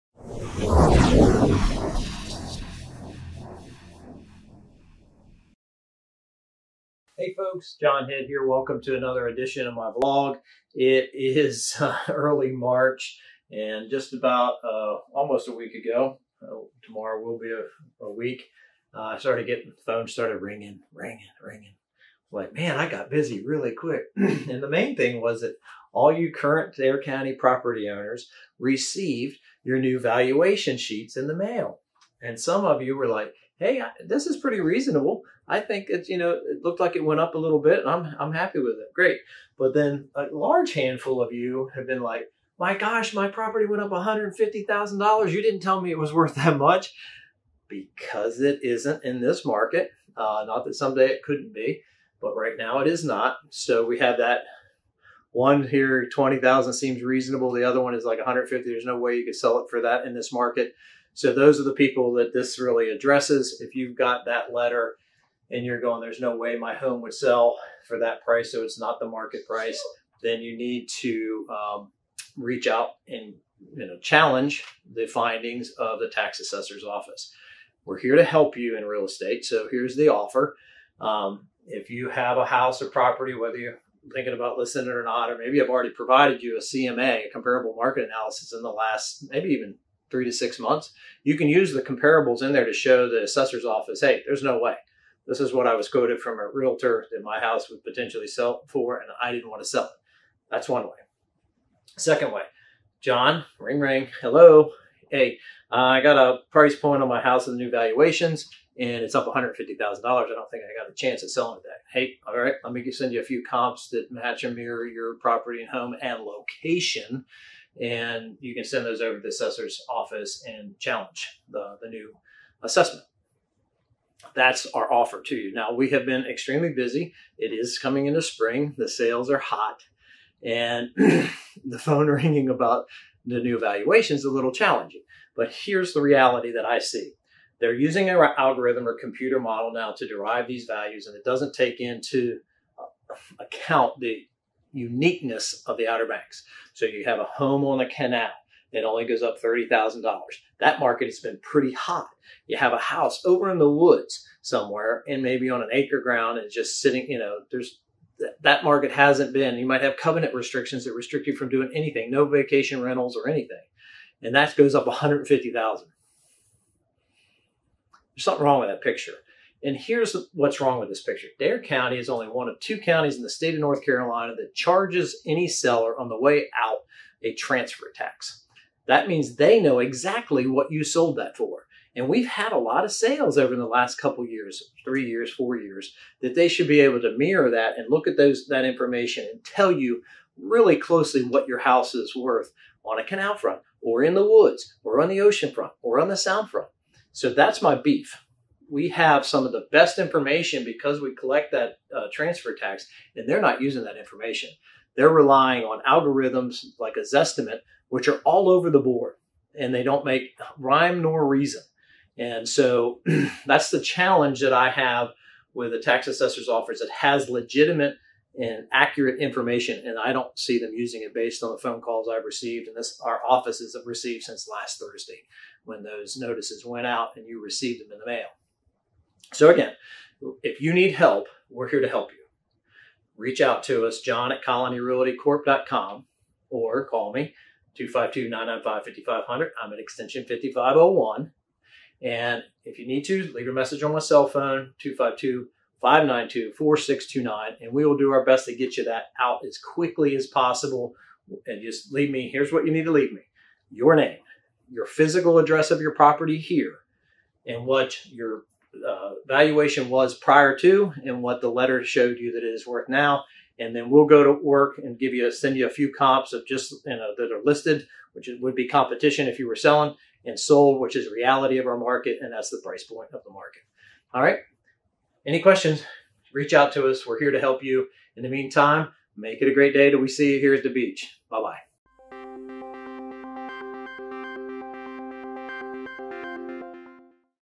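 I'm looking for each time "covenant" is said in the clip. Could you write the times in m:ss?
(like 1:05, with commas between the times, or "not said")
2:39.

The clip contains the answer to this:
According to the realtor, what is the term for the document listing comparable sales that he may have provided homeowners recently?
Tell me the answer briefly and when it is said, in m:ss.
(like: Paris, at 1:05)
comparable market analysis, at 1:27.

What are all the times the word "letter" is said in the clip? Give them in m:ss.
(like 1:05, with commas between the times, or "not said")
1:04, 4:21.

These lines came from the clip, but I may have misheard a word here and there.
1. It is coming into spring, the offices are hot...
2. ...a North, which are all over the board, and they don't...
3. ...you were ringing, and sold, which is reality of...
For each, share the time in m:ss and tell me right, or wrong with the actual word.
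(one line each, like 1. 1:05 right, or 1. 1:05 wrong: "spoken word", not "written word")
1. 2:07 wrong: "sales", not "offices"
2. 3:26 wrong: "Zestimate", not "North"
3. 4:29 wrong: "selling", not "ringing".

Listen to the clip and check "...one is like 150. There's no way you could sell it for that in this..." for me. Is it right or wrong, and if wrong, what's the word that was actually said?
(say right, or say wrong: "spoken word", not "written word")
right.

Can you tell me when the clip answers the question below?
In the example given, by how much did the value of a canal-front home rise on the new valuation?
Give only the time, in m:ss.
2:29.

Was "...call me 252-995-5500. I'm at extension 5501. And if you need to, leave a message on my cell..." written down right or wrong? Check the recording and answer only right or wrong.
right.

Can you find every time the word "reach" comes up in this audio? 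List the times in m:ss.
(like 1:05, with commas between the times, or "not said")
1:12, 3:53, 4:36.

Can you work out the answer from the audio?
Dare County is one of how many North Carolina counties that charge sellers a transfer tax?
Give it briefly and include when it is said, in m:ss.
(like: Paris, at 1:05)
2, at 2:52.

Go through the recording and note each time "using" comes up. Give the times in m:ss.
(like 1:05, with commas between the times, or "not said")
2:17, 3:23, 3:40.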